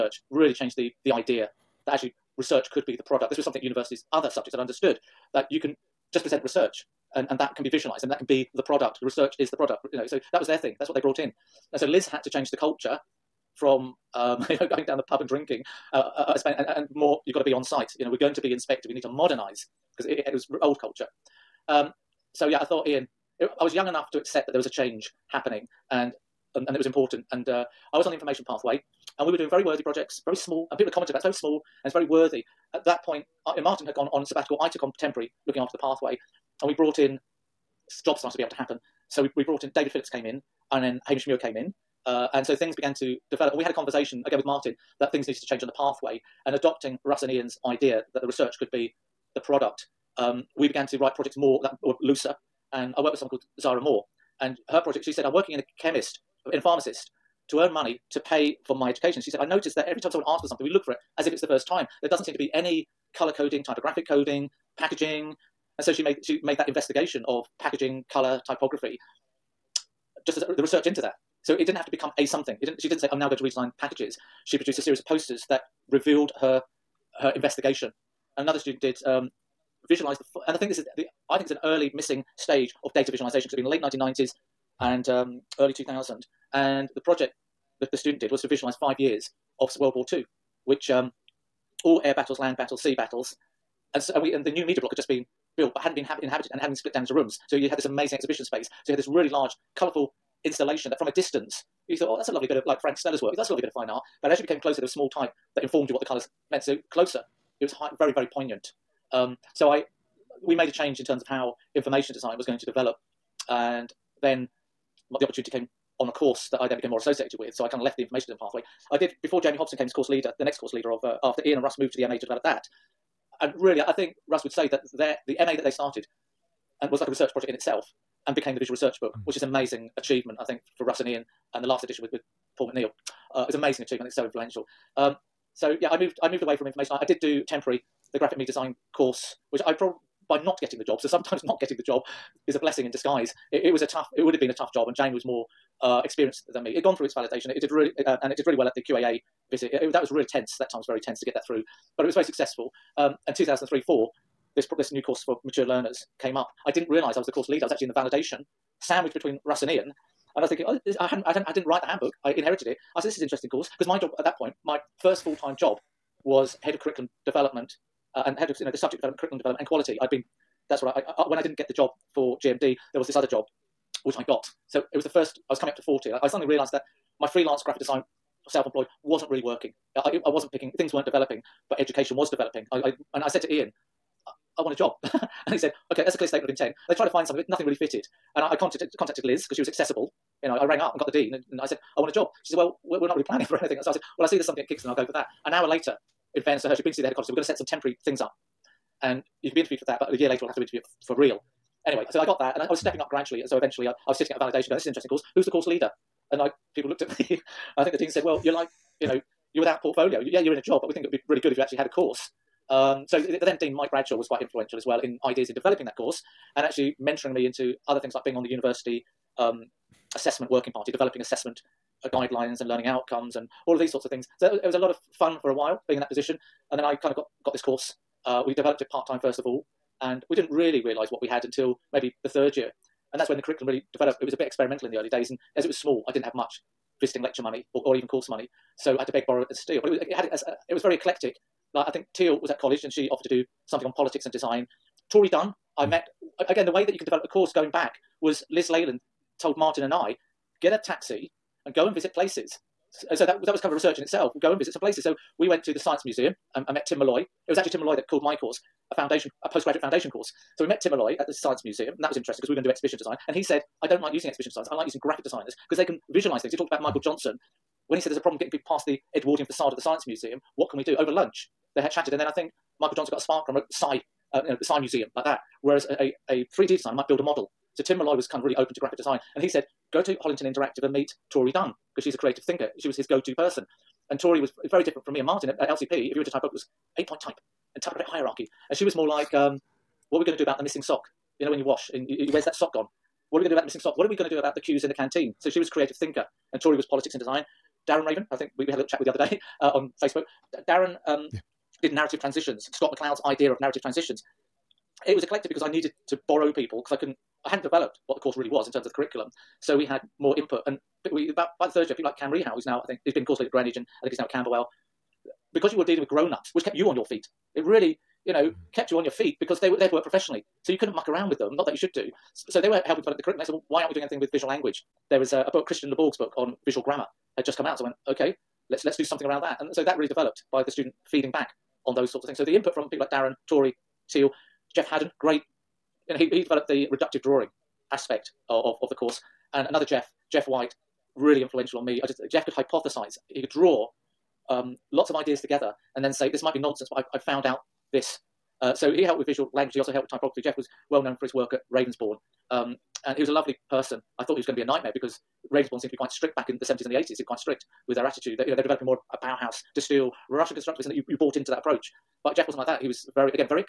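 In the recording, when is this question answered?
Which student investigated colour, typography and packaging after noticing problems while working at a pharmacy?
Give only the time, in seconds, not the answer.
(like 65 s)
53 s.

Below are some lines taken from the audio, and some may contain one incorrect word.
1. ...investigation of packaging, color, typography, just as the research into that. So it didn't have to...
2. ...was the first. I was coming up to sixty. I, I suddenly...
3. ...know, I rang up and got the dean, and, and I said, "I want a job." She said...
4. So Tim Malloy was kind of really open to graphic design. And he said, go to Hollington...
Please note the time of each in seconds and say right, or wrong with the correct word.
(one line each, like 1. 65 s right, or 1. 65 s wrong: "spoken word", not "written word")
1. 66 s right
2. 174 s wrong: "forty", not "sixty"
3. 190 s right
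4. 277 s right.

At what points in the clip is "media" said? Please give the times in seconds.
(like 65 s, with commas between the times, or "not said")
94 s, 138 s.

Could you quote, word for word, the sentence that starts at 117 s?
So I kind of left the information pathway.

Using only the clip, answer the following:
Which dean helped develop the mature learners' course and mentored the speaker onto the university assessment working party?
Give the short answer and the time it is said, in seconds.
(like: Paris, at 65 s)
Mike Bradshaw, at 213 s.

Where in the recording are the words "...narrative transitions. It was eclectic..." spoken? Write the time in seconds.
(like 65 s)
303 s.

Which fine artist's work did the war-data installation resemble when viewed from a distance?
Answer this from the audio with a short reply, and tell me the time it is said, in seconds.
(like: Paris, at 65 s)
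Frank Stella, at 102 s.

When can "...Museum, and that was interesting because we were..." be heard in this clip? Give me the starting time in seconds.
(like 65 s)
261 s.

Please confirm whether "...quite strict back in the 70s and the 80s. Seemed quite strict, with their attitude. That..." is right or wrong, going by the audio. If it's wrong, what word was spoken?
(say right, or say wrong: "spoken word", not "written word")
right.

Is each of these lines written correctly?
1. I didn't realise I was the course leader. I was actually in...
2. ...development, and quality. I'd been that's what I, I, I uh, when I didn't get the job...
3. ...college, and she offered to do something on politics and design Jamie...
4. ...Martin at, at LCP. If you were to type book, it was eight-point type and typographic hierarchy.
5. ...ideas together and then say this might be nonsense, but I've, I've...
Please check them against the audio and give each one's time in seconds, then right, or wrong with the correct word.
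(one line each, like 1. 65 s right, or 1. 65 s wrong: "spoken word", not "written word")
1. 156 s right
2. 169 s right
3. 242 s wrong: "Tory", not "Jamie"
4. 285 s right
5. 345 s right.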